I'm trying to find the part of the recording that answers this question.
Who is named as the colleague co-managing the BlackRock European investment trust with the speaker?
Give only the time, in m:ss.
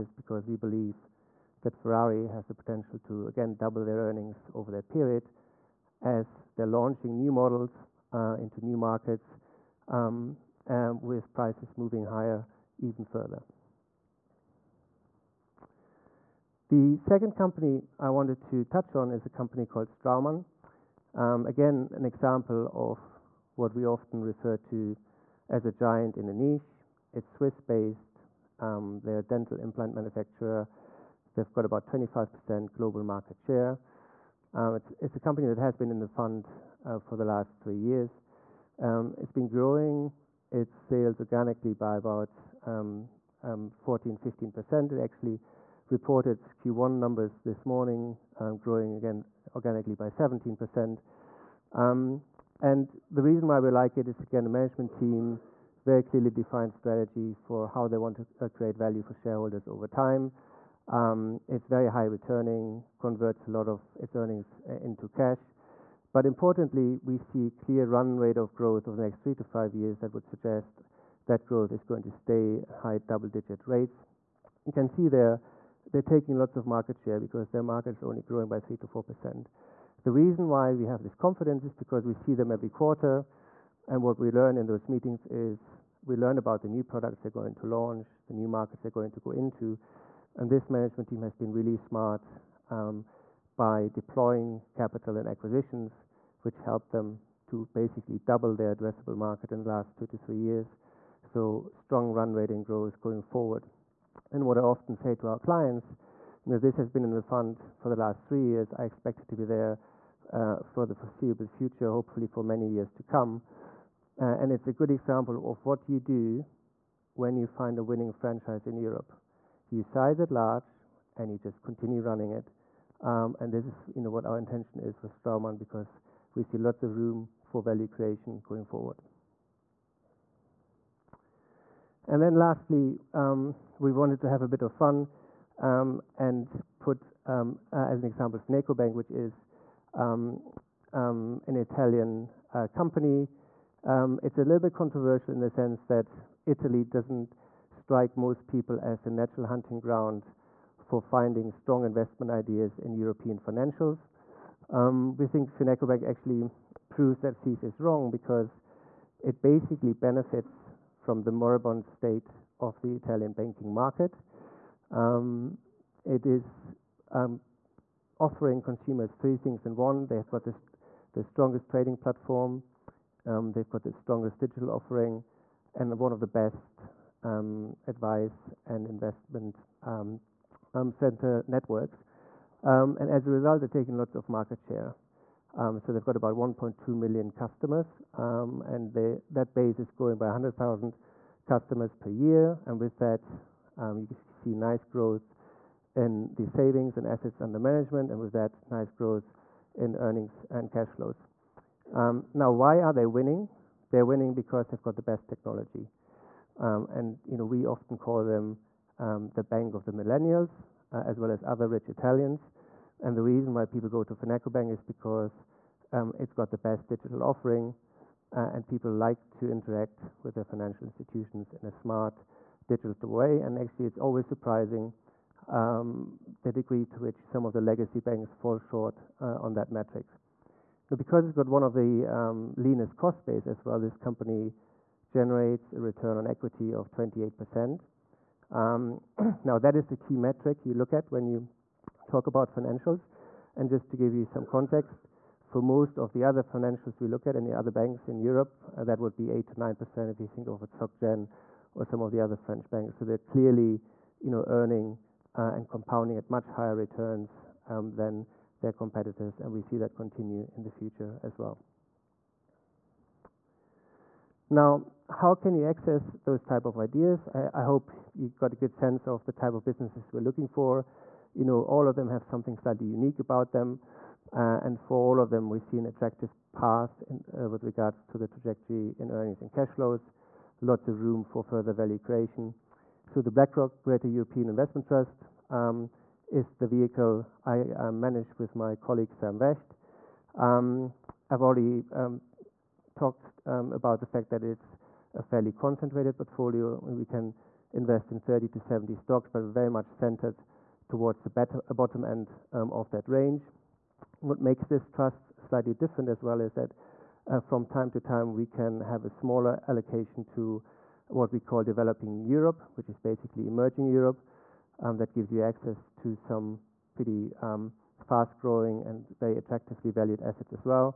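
4:49.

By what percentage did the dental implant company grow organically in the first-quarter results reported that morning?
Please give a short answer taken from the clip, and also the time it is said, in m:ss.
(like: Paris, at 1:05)
17%, at 0:50.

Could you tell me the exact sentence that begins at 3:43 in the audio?
And actually, it's always surprising um, the degree to which some of the legacy banks fall short uh, on that metric.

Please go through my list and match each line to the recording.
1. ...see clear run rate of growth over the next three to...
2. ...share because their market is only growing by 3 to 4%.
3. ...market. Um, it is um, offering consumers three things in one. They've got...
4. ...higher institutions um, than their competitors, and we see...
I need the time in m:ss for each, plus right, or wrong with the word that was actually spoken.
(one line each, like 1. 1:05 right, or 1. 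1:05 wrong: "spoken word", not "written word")
1. 1:07 right
2. 1:16 right
3. 2:43 right
4. 4:16 wrong: "returns", not "institutions".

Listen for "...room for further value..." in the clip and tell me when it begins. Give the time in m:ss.
4:41.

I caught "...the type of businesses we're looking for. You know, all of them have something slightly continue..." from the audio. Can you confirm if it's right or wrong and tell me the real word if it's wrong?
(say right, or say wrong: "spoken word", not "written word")
wrong: "unique", not "continue".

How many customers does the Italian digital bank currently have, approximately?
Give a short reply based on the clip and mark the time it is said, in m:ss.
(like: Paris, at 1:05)
1.2 million, at 3:06.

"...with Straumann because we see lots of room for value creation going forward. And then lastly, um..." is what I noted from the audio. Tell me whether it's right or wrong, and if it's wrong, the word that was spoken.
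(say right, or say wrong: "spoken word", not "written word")
right.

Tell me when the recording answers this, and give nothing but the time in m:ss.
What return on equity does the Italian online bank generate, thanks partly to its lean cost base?
3:56.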